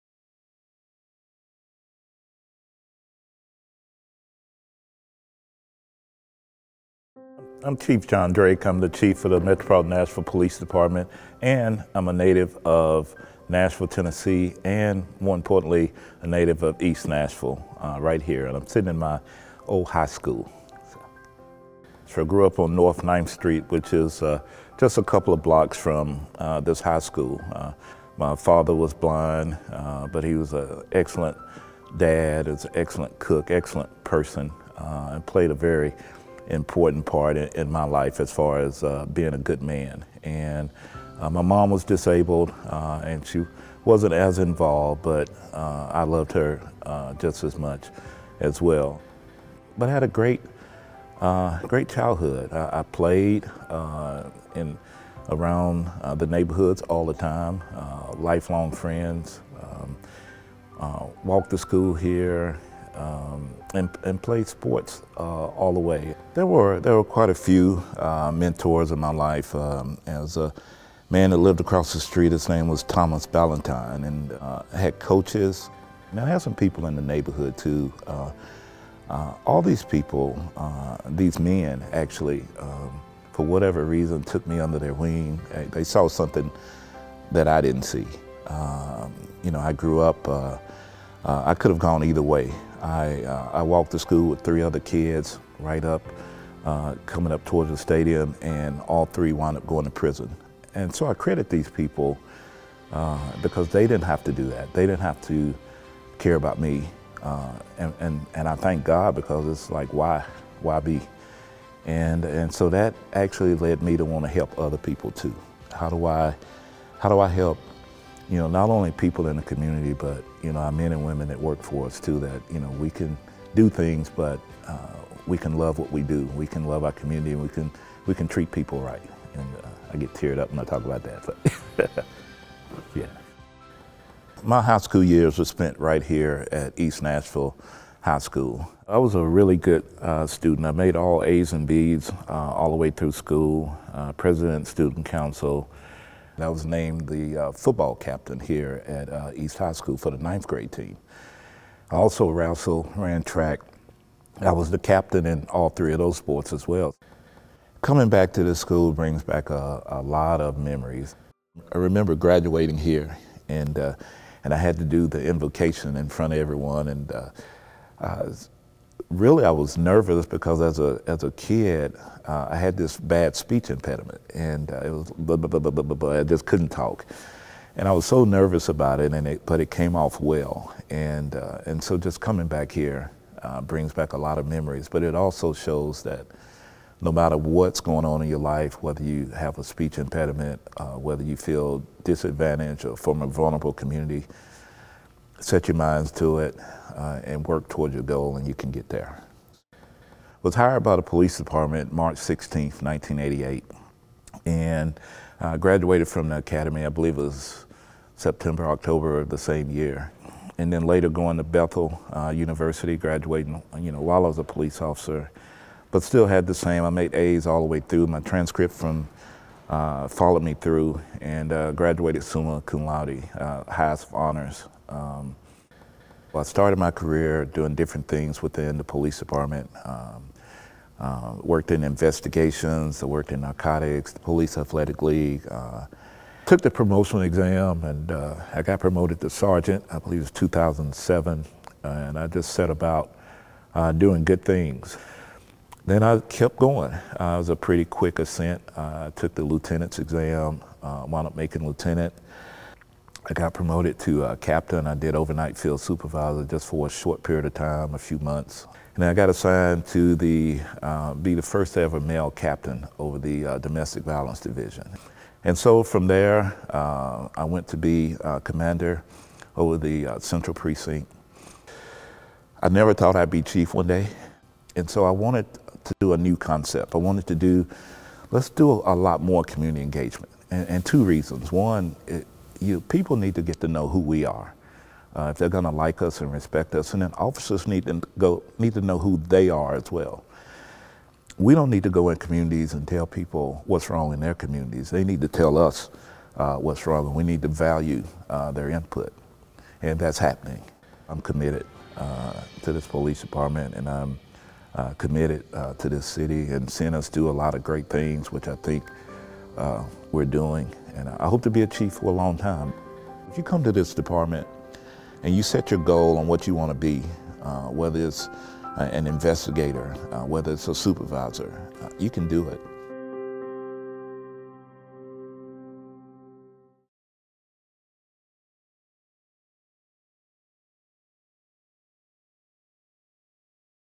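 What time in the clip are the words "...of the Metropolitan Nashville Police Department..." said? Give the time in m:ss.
0:09.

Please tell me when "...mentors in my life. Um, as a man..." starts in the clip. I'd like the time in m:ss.
1:08.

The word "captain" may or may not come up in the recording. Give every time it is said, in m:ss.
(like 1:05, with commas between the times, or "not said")
2:27, 2:34, 4:14, 4:22.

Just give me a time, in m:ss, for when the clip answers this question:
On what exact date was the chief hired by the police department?
3:21.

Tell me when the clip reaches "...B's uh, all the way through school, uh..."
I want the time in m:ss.
2:21.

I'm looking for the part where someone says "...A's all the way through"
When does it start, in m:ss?
3:37.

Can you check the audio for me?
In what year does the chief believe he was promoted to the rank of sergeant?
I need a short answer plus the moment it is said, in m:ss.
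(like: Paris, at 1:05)
2007, at 4:00.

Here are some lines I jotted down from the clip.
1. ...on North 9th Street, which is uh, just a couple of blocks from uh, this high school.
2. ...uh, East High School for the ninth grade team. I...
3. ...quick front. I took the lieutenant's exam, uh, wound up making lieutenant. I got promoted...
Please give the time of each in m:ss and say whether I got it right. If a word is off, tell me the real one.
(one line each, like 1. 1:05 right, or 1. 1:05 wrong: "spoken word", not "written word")
1. 0:22 right
2. 2:29 right
3. 4:07 wrong: "ascent", not "front".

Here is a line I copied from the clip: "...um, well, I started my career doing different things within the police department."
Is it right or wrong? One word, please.
right.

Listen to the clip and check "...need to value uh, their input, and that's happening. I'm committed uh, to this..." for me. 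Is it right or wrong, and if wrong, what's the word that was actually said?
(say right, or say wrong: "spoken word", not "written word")
right.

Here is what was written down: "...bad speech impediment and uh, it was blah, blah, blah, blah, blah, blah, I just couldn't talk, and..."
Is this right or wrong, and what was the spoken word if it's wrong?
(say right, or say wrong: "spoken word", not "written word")
right.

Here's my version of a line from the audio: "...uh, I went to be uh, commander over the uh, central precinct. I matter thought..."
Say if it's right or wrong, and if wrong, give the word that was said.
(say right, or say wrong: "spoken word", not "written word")
wrong: "never", not "matter".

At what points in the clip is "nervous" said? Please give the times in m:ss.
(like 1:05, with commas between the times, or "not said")
2:49, 2:58.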